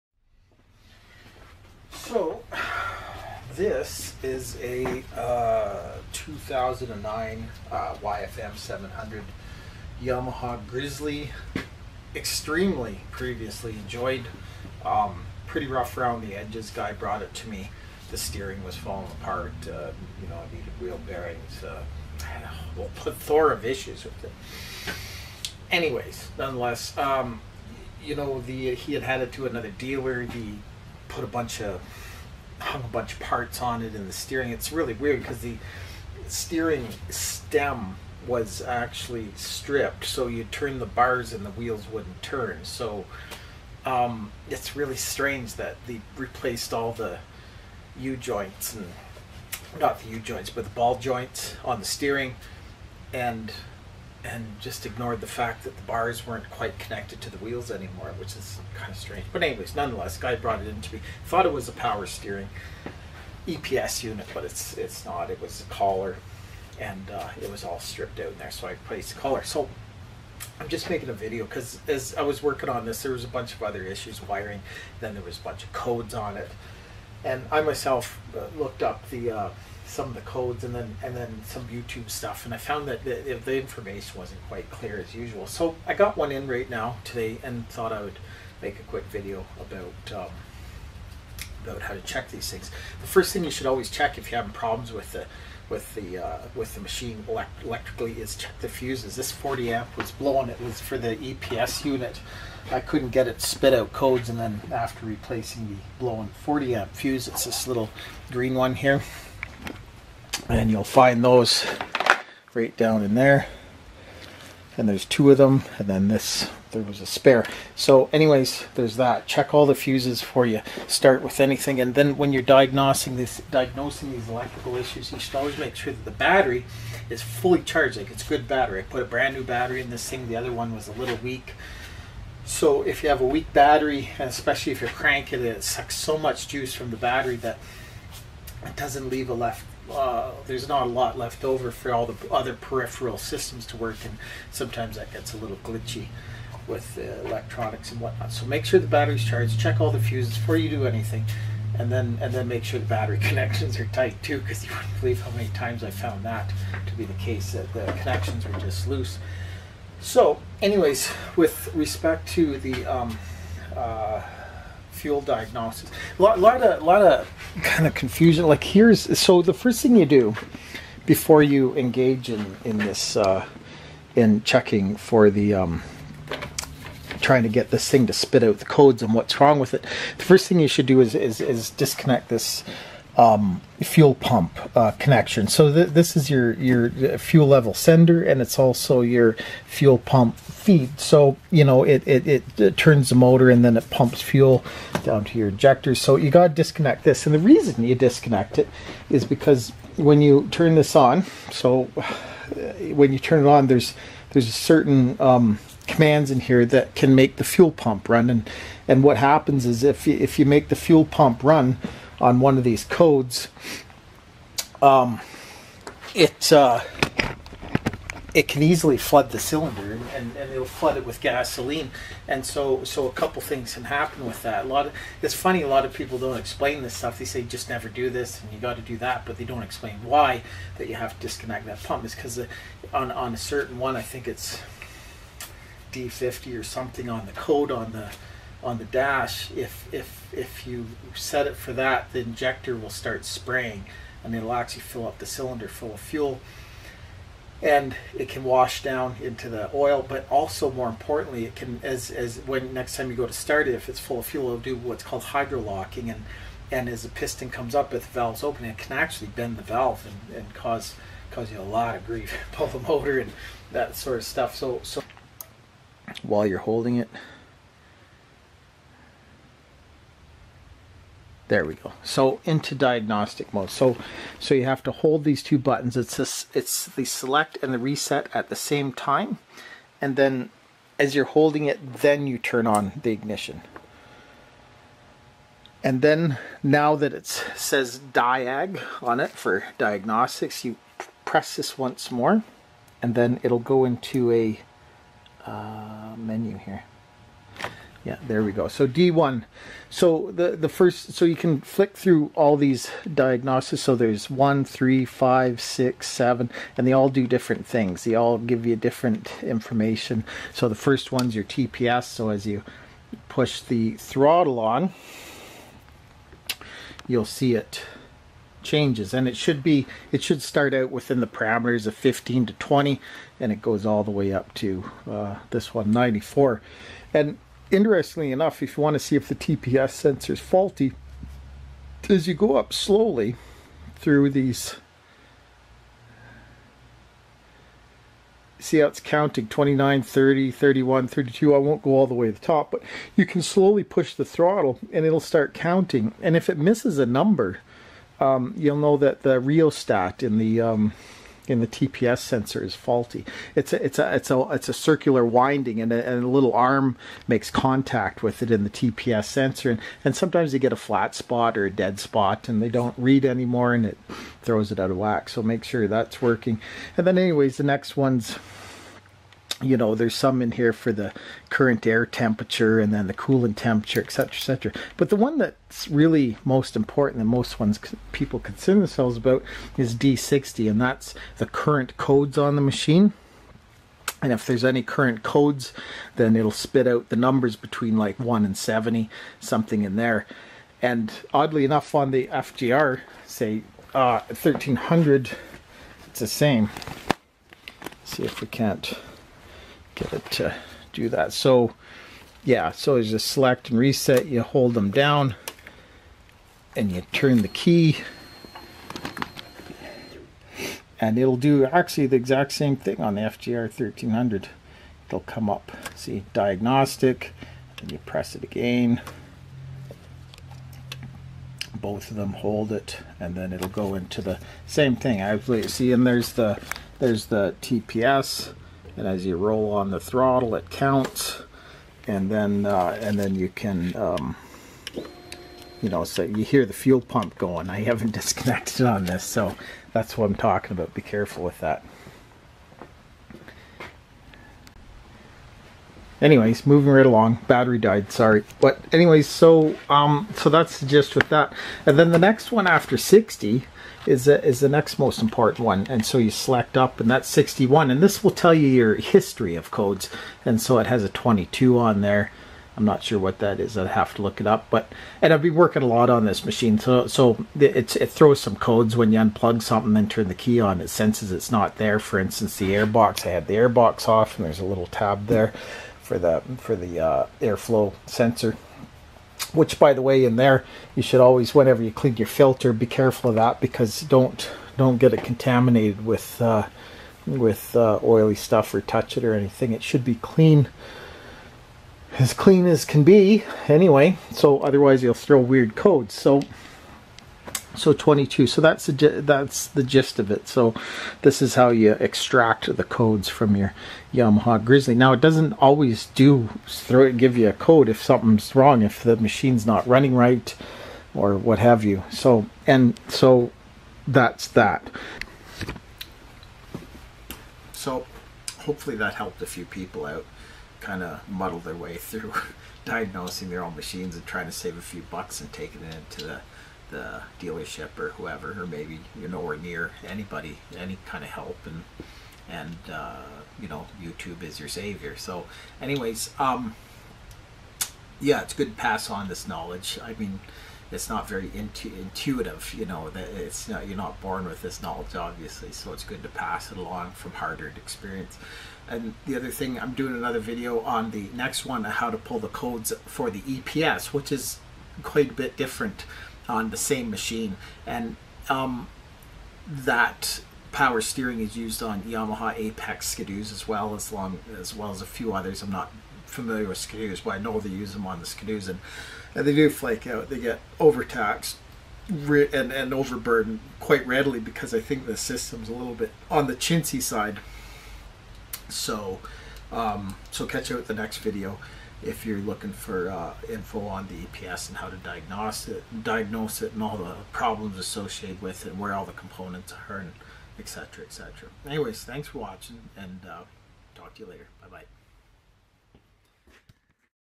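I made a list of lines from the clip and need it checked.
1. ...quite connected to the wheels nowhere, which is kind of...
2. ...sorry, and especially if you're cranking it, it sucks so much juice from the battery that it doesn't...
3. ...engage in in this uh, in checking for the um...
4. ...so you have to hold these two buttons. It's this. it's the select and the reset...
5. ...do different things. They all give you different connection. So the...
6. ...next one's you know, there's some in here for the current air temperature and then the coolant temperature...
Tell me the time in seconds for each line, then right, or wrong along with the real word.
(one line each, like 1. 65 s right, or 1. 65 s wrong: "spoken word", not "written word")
1. 56 s wrong: "anymore", not "nowhere"
2. 133 s wrong: "battery", not "sorry"
3. 171 s right
4. 274 s right
5. 307 s wrong: "information", not "connection"
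6. 367 s right.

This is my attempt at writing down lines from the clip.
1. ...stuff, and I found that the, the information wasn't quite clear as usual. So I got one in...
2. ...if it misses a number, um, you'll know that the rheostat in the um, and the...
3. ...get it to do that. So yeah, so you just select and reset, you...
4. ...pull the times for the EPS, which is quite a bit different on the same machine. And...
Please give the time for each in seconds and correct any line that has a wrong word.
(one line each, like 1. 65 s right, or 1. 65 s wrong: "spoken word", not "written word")
1. 82 s right
2. 346 s right
3. 400 s right
4. 552 s wrong: "codes", not "times".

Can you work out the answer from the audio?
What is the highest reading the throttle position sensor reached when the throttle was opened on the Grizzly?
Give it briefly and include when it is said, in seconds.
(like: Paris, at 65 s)
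94, at 325 s.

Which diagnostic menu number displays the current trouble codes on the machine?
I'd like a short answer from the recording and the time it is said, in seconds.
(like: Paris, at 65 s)
D60, at 379 s.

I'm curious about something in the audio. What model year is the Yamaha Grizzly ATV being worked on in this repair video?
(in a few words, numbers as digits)
2009.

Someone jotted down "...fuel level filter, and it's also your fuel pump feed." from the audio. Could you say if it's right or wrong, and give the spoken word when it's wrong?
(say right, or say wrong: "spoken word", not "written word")
wrong: "sender", not "filter".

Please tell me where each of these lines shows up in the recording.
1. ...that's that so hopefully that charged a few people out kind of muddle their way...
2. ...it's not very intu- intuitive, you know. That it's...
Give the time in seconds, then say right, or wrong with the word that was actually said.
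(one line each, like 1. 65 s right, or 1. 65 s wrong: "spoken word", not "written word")
1. 514 s wrong: "helped", not "charged"
2. 540 s right.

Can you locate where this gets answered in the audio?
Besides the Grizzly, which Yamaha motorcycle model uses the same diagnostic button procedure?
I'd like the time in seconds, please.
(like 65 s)
392 s.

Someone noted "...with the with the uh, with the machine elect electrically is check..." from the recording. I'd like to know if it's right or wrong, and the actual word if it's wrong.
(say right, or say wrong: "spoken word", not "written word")
right.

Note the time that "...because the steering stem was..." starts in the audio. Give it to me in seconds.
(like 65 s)
35 s.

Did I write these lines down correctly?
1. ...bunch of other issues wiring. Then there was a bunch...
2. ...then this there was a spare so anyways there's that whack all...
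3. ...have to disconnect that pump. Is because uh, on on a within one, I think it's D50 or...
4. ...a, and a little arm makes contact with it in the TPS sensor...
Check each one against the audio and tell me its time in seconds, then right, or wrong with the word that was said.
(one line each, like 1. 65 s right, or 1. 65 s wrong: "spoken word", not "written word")
1. 73 s right
2. 115 s wrong: "check", not "whack"
3. 230 s wrong: "certain", not "within"
4. 355 s right.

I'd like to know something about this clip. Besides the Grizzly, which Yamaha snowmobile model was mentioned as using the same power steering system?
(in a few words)
Apex.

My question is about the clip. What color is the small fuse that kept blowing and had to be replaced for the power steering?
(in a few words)
Green.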